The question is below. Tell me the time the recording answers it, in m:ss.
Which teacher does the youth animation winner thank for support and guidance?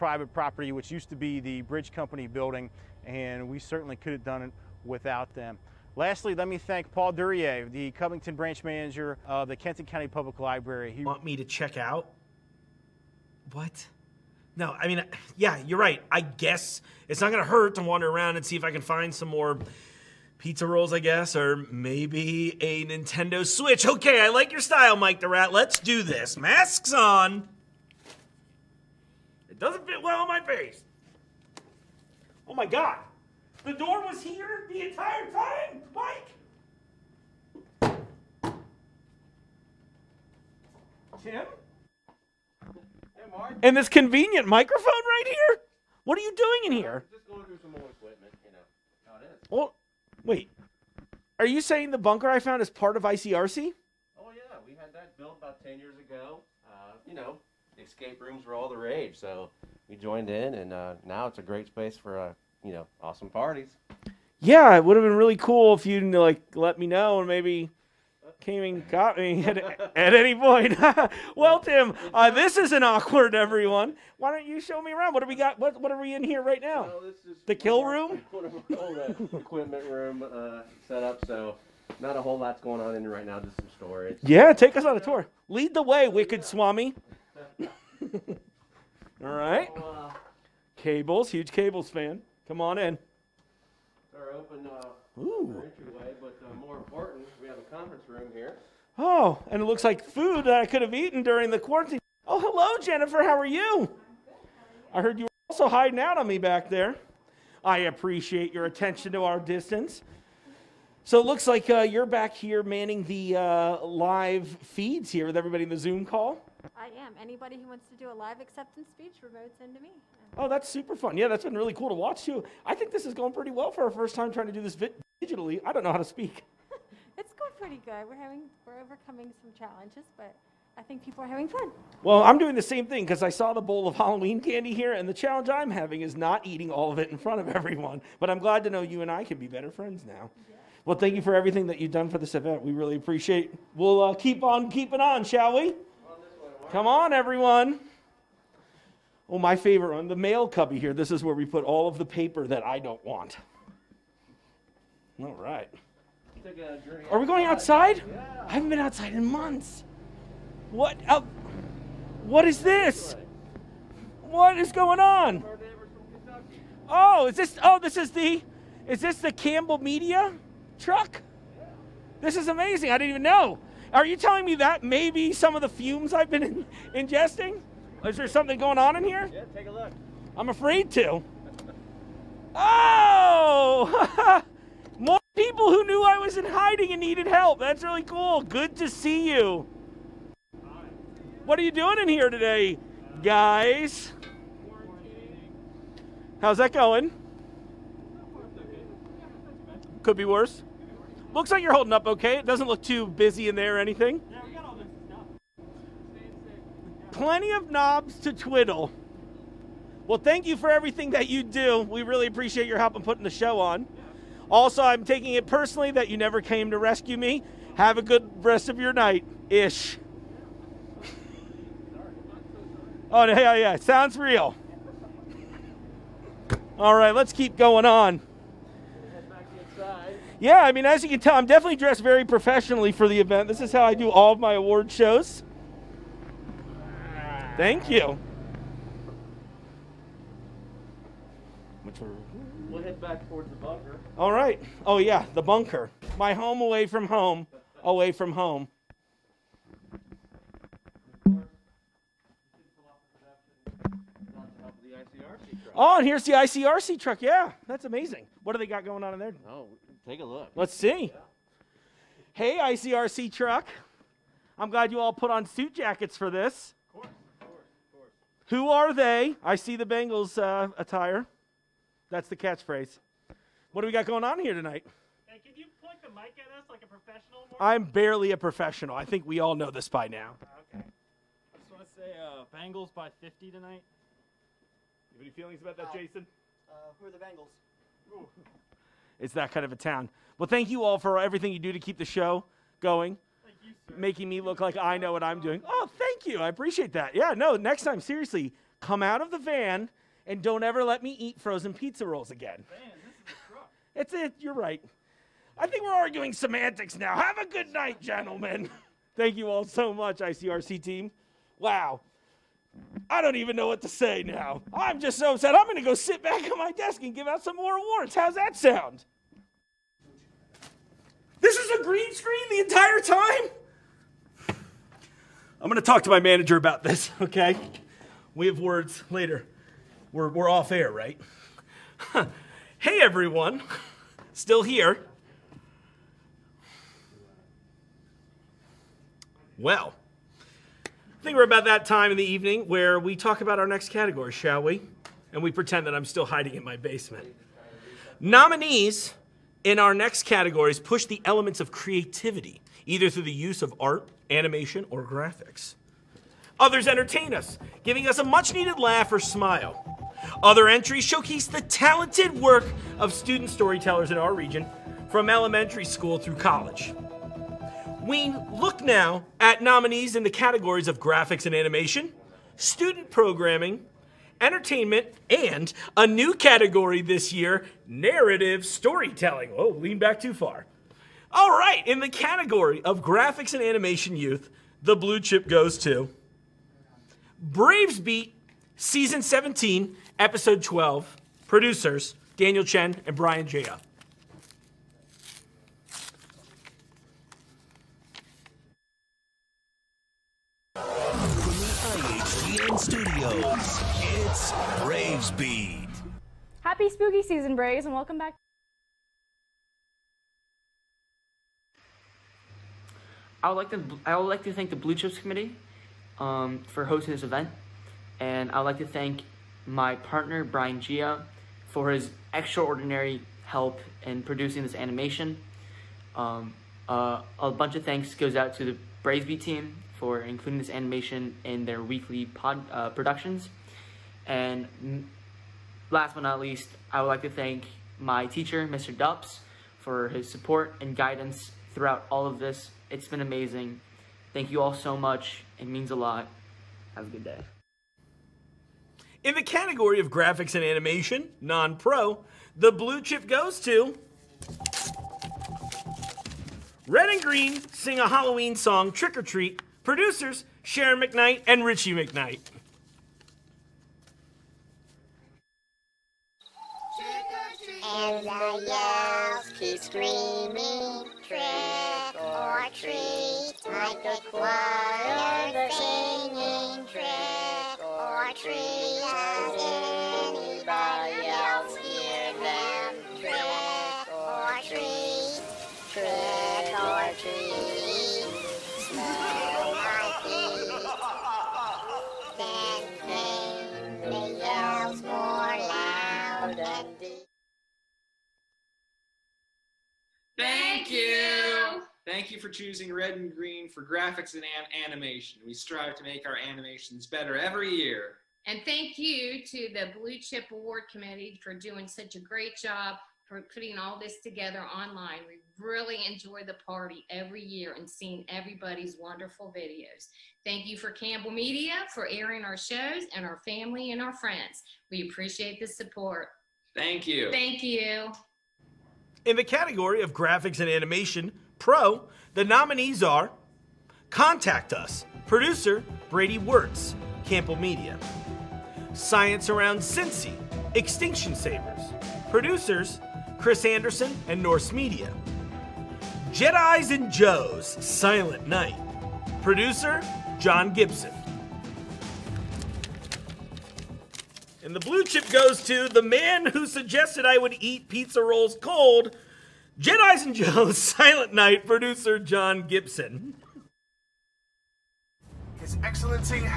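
7:18.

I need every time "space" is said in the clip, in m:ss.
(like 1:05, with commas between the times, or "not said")
1:01.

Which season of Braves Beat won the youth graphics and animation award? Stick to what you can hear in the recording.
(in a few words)
Season 17.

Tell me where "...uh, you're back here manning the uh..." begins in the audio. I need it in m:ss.
1:51.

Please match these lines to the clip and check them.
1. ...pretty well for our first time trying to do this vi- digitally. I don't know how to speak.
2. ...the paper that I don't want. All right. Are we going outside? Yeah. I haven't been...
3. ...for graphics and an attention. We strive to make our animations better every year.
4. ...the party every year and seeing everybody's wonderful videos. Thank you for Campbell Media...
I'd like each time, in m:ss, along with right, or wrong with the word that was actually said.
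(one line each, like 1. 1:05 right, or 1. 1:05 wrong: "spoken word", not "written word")
1. 2:03 right
2. 2:31 right
3. 8:23 wrong: "animation", not "attention"
4. 8:36 right.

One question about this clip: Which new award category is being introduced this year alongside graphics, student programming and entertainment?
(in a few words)
narrative storytelling.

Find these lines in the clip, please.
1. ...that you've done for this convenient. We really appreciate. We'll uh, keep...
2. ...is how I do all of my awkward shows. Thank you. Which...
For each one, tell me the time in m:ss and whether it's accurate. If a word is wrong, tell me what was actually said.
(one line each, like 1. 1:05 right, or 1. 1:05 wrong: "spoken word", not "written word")
1. 2:21 wrong: "event", not "convenient"
2. 3:53 wrong: "award", not "awkward".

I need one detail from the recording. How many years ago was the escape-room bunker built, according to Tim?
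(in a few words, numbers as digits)
10 years.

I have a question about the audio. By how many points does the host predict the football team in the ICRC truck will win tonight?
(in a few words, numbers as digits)
50.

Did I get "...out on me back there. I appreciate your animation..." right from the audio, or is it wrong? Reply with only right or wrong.
wrong.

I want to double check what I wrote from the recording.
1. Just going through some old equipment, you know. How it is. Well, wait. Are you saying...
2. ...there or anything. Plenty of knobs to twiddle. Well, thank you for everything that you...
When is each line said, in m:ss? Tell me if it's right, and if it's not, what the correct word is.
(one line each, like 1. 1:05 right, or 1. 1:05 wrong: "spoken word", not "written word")
1. 0:47 right
2. 3:23 right.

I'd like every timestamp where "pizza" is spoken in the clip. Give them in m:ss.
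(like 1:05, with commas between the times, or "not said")
0:20, 5:01, 9:17.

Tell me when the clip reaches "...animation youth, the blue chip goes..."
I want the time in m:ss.
6:23.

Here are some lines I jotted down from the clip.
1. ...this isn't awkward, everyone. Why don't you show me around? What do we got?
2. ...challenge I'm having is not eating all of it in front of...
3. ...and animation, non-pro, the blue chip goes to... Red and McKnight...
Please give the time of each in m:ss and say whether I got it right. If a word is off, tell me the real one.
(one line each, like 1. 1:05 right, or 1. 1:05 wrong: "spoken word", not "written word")
1. 1:12 right
2. 2:15 right
3. 7:30 wrong: "Green", not "McKnight".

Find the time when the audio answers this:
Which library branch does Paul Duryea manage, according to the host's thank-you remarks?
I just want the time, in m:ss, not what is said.
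0:07.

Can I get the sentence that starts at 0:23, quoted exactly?
Okay, I like your style, Mike the Rat.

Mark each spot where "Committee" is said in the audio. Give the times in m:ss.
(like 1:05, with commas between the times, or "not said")
6:55, 8:30.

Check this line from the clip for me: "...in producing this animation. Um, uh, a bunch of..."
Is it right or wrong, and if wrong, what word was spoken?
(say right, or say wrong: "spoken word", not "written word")
right.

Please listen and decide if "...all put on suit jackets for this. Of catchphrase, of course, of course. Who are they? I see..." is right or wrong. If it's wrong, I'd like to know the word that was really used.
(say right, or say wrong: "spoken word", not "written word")
wrong: "course", not "catchphrase".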